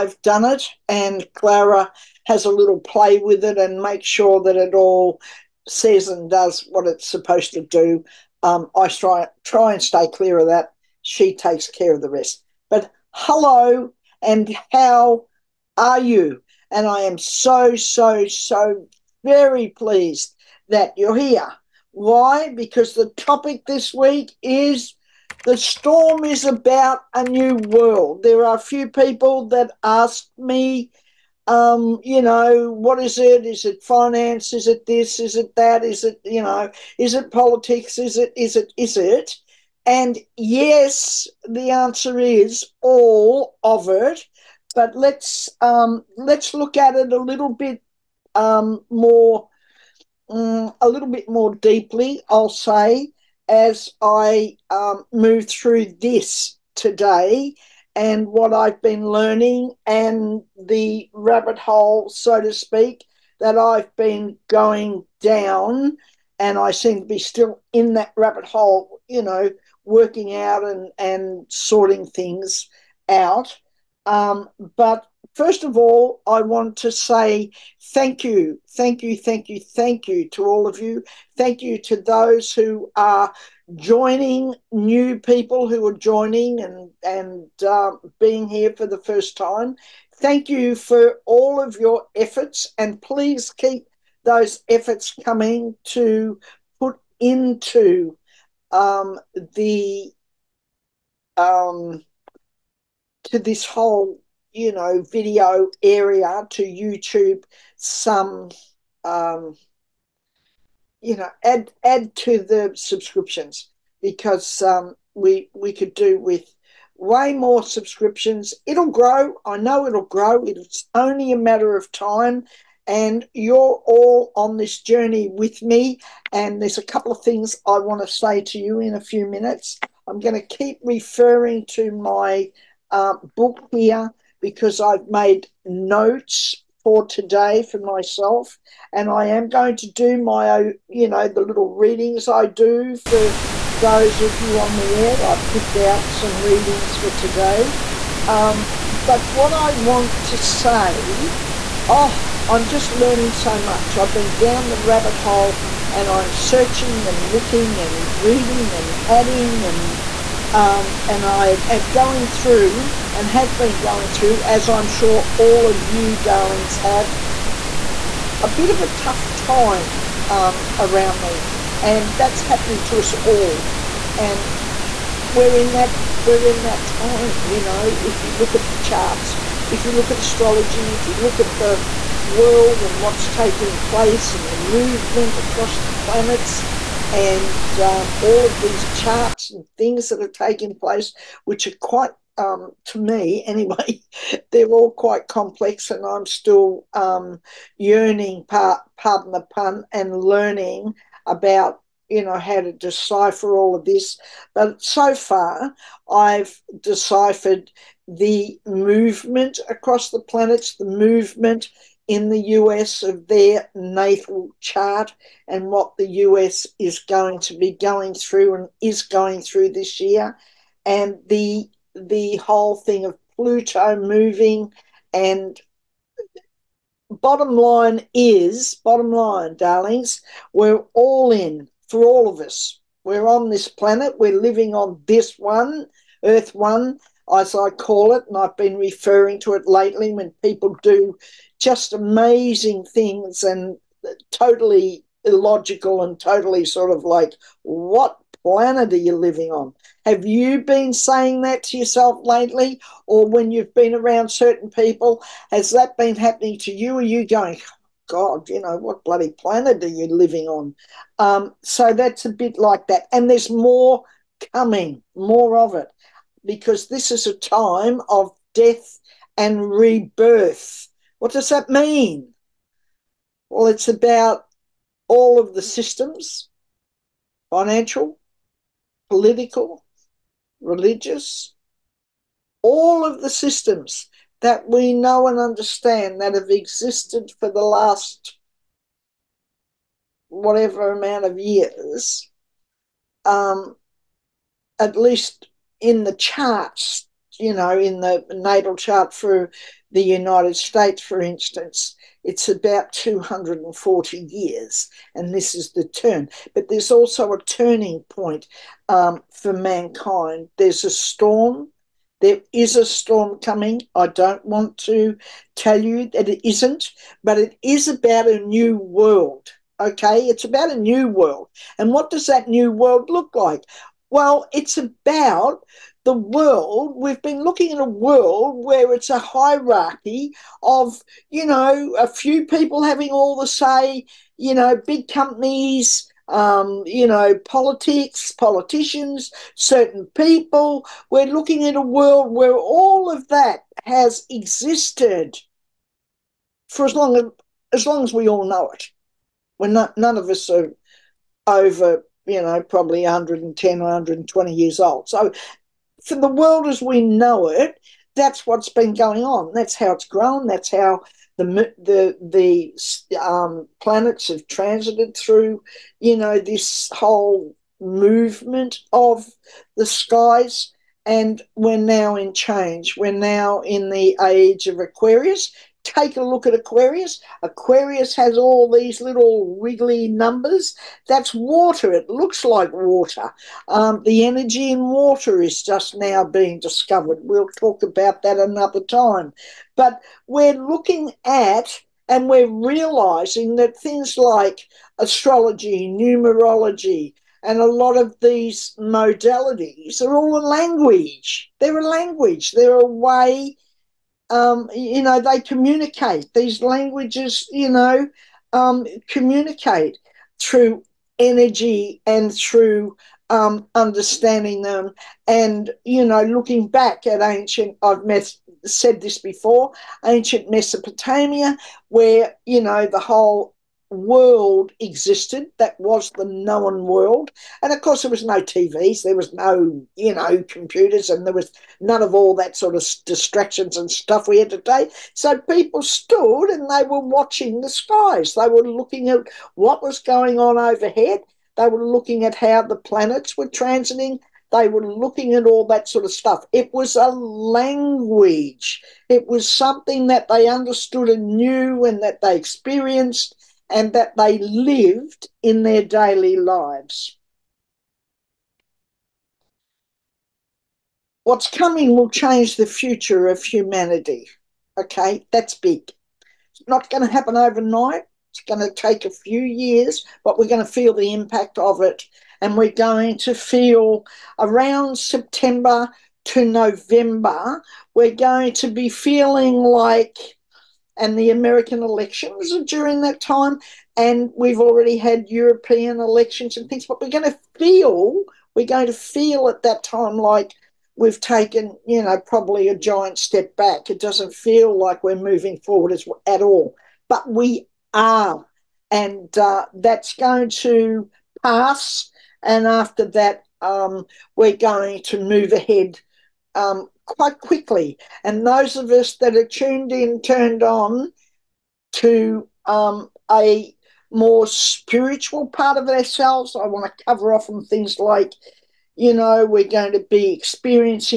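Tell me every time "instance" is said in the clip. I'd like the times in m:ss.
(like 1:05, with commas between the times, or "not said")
5:01.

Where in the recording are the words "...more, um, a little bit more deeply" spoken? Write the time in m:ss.
0:48.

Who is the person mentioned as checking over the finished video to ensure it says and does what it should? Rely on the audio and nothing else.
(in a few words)
Clara.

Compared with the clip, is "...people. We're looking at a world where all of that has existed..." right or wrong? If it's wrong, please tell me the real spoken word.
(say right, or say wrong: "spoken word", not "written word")
right.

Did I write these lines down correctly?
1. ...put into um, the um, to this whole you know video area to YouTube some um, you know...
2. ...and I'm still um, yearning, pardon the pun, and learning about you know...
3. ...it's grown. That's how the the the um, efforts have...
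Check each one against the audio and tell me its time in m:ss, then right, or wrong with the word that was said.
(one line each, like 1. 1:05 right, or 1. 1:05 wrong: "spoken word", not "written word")
1. 1:36 right
2. 3:15 right
3. 5:59 wrong: "planets", not "efforts".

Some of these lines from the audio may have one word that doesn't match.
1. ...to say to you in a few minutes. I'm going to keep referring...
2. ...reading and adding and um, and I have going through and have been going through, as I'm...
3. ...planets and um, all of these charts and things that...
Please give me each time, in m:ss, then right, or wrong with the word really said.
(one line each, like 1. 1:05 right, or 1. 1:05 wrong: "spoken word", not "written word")
1. 2:07 right
2. 2:38 right
3. 3:05 right.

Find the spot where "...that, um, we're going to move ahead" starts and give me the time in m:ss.
8:23.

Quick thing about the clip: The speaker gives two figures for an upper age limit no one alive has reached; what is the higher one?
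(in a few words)
120.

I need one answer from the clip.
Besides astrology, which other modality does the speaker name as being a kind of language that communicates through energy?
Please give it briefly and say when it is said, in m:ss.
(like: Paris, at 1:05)
numerology, at 6:35.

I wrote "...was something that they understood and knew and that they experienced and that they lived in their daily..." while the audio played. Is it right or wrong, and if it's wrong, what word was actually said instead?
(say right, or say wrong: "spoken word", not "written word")
right.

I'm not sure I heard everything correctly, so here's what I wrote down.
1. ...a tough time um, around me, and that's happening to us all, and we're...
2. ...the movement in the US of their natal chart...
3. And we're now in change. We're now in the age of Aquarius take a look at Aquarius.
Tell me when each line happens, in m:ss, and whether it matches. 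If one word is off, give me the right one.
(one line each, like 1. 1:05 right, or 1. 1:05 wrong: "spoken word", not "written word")
1. 2:48 right
2. 3:30 right
3. 6:11 right.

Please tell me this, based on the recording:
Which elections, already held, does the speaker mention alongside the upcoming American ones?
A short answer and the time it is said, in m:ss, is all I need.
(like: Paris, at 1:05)
European elections, at 8:05.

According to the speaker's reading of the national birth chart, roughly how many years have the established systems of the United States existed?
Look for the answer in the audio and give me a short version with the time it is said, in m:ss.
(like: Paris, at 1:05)
240, at 5:02.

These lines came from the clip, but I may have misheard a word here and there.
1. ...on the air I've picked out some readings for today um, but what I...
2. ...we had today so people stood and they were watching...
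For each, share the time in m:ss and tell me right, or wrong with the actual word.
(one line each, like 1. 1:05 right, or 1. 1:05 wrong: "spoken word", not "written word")
1. 2:24 right
2. 7:14 right.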